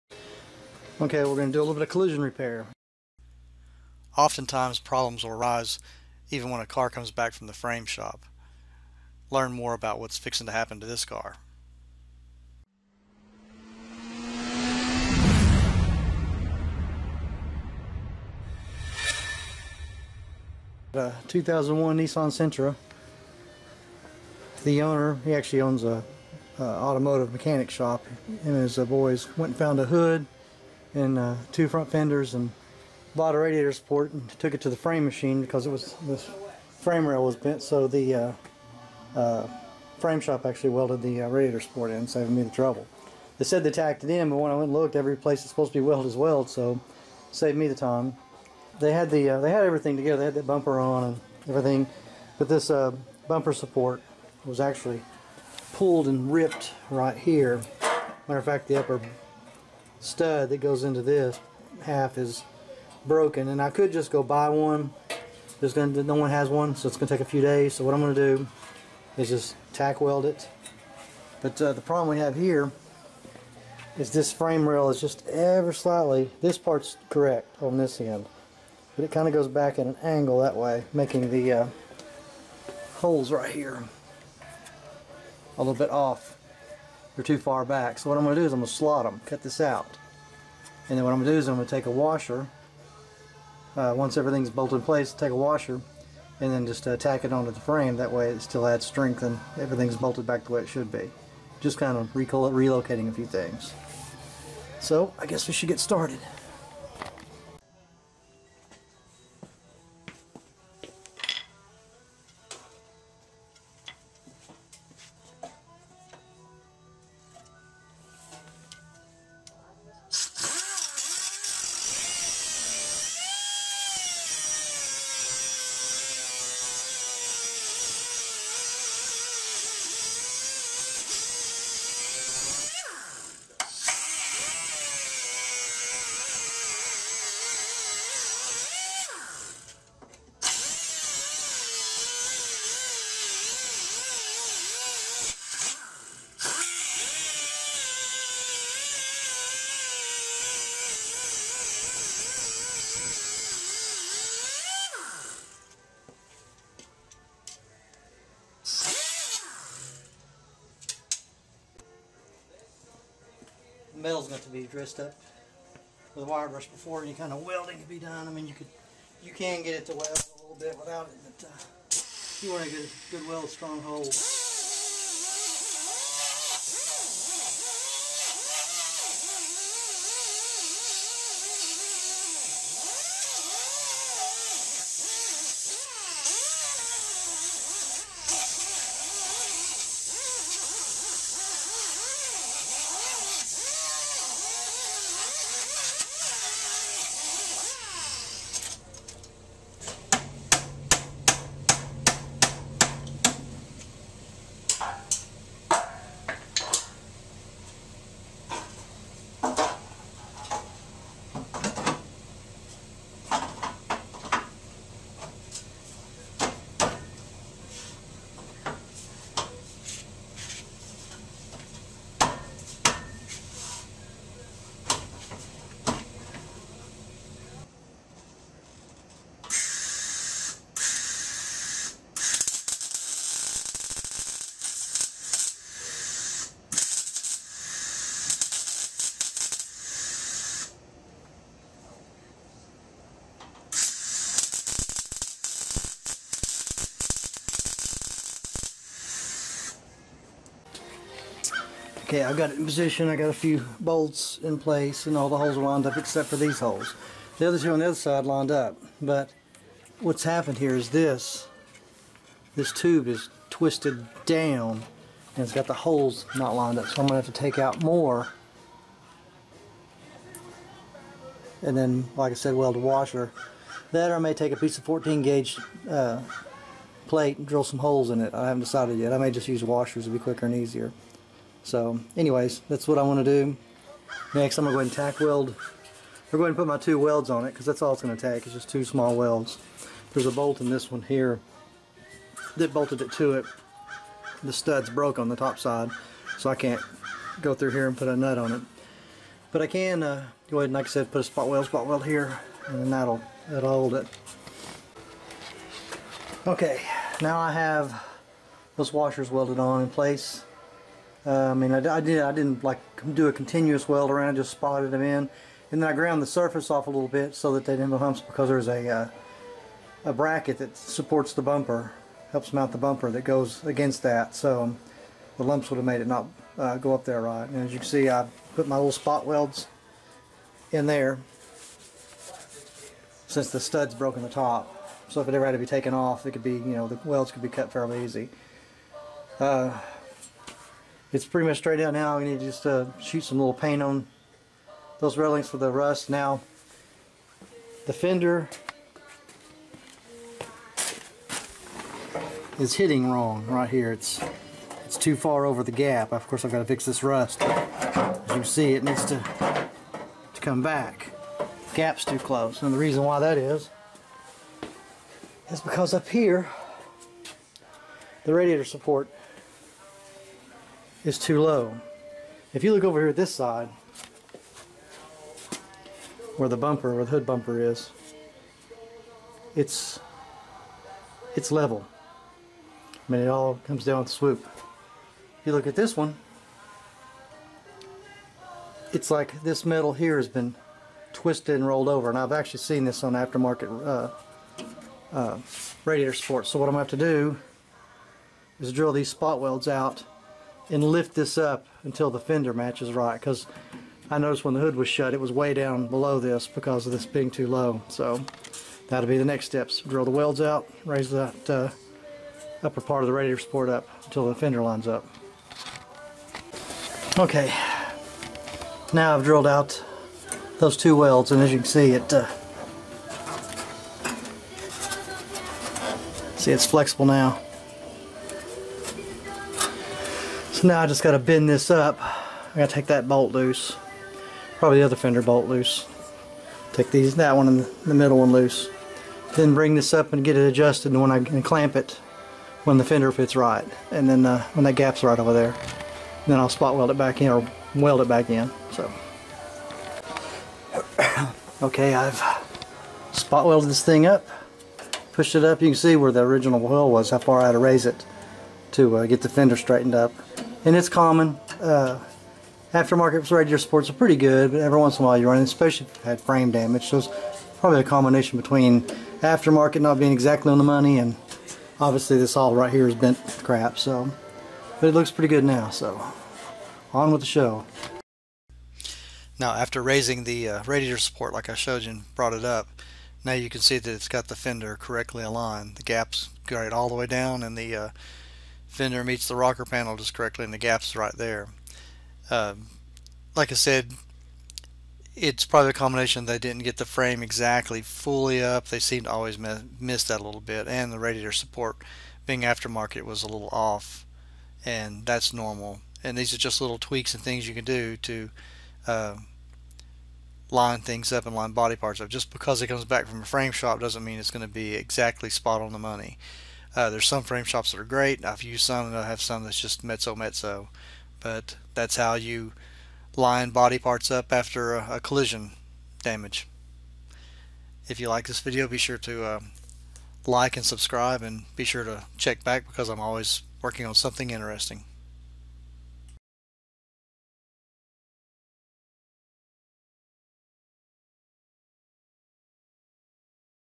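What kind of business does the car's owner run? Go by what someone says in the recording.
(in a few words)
automotive mechanic shop.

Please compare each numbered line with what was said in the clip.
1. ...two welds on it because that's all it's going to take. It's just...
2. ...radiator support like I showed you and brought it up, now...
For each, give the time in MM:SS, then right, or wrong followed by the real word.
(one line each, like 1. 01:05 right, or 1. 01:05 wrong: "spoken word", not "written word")
1. 04:46 right
2. 08:00 right.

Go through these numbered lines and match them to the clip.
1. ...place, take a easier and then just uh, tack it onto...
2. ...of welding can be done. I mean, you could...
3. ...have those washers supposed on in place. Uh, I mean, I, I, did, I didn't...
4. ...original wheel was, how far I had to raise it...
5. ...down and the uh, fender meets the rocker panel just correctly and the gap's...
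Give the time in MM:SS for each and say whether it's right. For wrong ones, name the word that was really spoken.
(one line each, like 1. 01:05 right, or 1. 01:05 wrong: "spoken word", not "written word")
1. 01:34 wrong: "washer", not "easier"
2. 02:47 right
3. 05:07 wrong: "welded", not "supposed"
4. 07:36 right
5. 08:07 right.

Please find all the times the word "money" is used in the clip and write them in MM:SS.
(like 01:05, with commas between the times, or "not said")
07:50, 08:35.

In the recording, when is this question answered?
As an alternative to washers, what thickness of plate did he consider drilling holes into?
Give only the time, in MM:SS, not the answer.
04:34.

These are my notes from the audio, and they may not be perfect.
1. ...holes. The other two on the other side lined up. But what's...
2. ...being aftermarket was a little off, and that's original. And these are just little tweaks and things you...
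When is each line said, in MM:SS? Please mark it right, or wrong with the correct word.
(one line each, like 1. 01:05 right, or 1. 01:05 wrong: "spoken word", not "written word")
1. 04:16 right
2. 08:22 wrong: "normal", not "original".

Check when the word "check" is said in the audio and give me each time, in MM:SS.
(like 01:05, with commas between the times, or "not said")
08:52.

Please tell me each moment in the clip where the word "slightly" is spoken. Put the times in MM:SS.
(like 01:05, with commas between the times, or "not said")
01:15.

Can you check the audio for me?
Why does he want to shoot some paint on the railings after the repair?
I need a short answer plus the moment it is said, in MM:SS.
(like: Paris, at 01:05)
for the rust, at 05:45.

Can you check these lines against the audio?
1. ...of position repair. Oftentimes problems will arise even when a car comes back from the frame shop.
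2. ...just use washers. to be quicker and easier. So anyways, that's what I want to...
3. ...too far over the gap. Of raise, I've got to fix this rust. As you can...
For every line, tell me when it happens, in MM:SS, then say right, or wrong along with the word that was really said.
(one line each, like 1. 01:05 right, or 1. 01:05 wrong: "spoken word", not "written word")
1. 00:01 wrong: "collision", not "position"
2. 04:39 right
3. 05:54 wrong: "course", not "raise".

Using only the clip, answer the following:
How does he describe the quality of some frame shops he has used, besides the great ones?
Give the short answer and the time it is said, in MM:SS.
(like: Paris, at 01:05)
mezzo mezzo, at 08:39.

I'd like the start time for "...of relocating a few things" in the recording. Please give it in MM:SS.
01:41.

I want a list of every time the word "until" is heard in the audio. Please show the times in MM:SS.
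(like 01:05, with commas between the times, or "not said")
06:41, 06:54.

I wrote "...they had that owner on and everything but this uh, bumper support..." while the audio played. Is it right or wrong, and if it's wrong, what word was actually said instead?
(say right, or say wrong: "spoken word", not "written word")
wrong: "bumper", not "owner".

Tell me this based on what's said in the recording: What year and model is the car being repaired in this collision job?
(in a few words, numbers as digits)
2001 Nissan Sentra.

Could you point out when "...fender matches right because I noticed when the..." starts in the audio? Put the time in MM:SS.
06:42.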